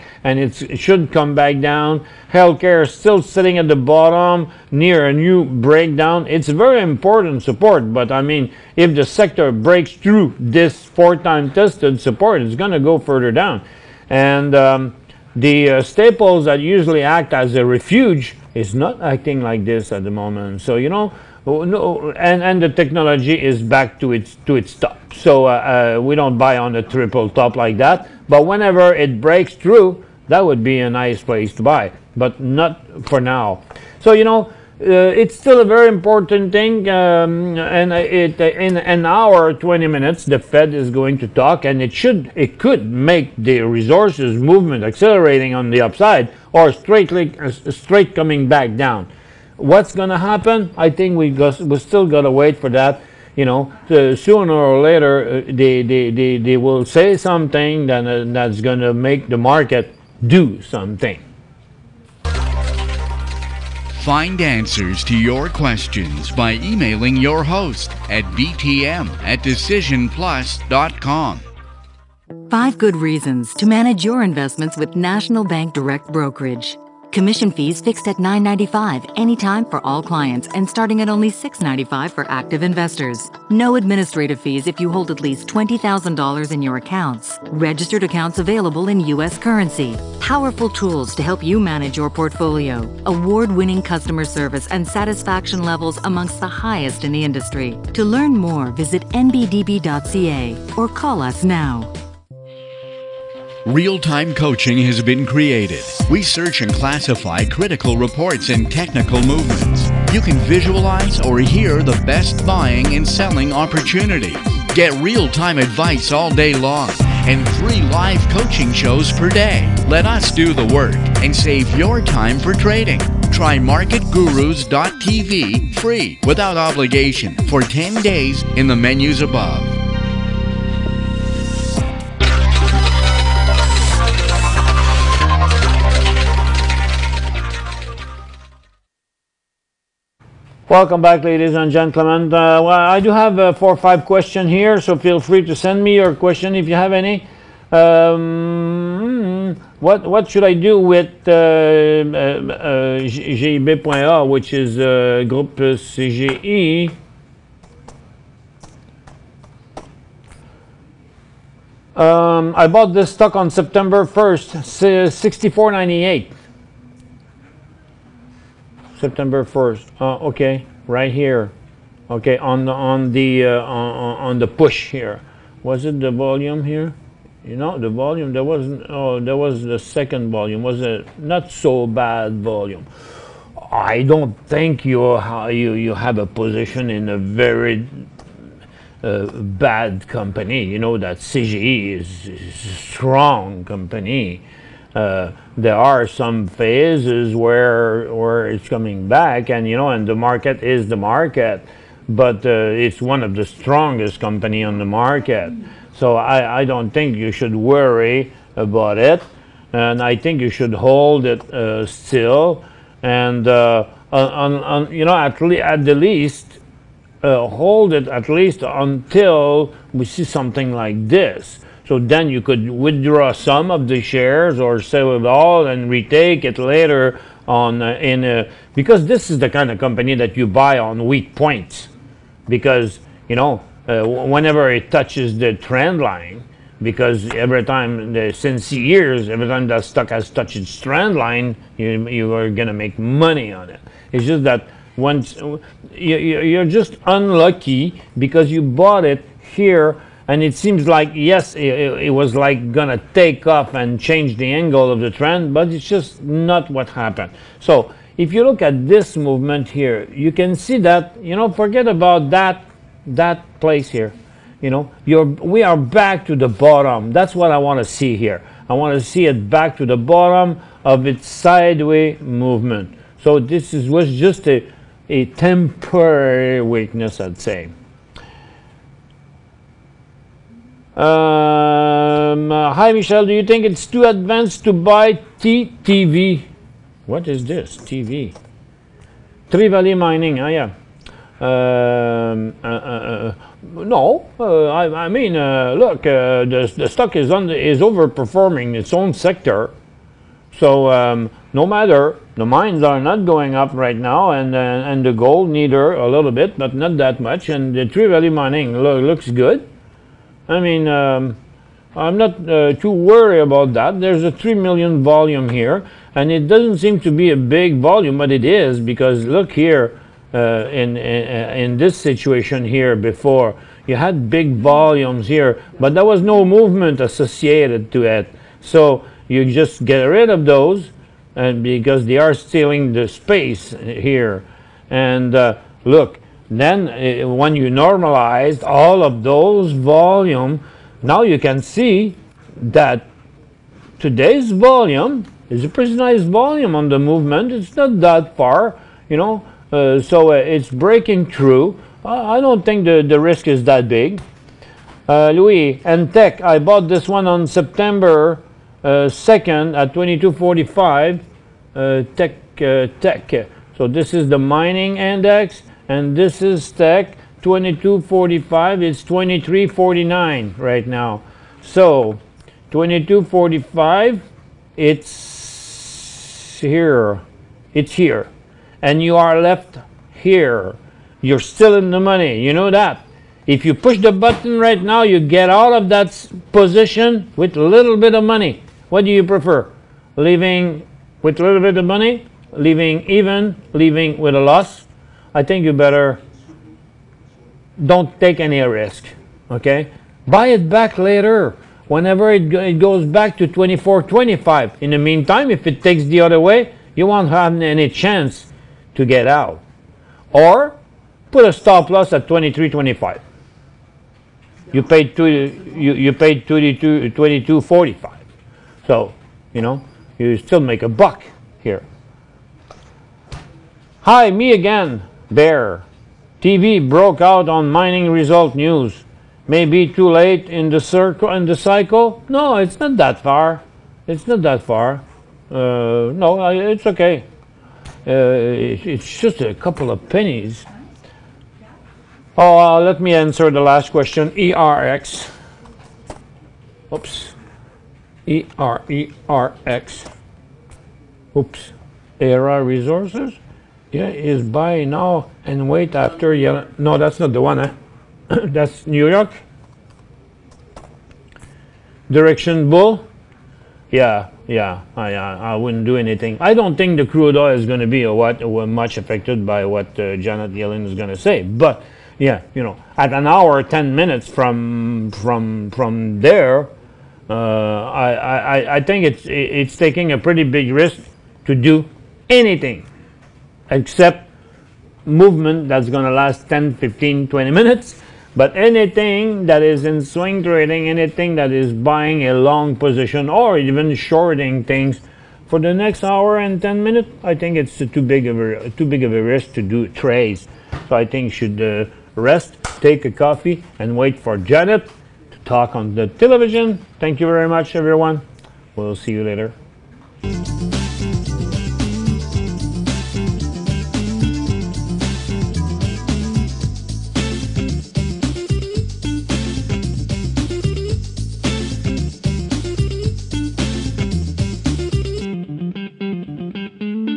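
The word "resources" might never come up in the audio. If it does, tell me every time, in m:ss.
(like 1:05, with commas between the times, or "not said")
0:43, 7:32.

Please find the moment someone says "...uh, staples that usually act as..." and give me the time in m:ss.
0:15.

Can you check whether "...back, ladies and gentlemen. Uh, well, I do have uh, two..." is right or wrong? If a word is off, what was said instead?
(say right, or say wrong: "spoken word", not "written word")
wrong: "four", not "two".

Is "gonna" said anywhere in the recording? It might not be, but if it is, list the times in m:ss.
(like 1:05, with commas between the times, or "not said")
0:49, 0:58, 4:12.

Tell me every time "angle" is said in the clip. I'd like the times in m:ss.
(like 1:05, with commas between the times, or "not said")
4:14.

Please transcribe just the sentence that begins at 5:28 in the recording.
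So you just get rid of those, and because they are stealing the space here.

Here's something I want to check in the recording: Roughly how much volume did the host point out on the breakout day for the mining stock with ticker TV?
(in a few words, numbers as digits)
3 million.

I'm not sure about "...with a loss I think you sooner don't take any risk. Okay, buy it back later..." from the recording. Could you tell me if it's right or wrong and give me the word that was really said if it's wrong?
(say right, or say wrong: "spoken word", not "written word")
wrong: "better", not "sooner".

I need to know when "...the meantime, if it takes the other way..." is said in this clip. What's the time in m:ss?
6:44.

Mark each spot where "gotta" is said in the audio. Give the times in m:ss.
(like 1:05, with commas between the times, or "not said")
0:52.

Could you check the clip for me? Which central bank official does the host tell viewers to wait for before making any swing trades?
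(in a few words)
Janet Yellen.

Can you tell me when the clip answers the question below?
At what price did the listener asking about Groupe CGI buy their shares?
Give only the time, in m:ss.
2:45.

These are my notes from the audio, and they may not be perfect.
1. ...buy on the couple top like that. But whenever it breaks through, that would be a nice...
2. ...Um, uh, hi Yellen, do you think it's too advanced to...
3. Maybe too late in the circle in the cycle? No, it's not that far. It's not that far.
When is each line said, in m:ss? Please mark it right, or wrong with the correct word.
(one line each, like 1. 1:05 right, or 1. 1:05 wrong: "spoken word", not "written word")
1. 0:26 wrong: "triple", not "couple"
2. 4:40 wrong: "Michelle", not "Yellen"
3. 7:09 right.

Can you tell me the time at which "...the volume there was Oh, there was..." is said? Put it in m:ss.
2:57.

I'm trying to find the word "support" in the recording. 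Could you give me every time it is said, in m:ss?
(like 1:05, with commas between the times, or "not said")
0:07, 0:11.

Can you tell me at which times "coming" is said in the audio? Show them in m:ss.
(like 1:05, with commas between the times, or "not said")
0:48, 3:18.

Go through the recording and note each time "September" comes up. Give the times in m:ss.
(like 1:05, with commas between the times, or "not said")
2:43, 2:48, 5:57.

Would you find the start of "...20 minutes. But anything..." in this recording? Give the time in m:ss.
8:07.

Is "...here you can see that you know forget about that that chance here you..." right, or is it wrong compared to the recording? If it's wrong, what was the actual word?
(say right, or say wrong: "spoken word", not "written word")
wrong: "place", not "chance".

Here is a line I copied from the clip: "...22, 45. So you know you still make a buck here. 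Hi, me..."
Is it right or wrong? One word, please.
right.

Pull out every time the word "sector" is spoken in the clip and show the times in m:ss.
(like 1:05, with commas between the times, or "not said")
0:09, 4:59.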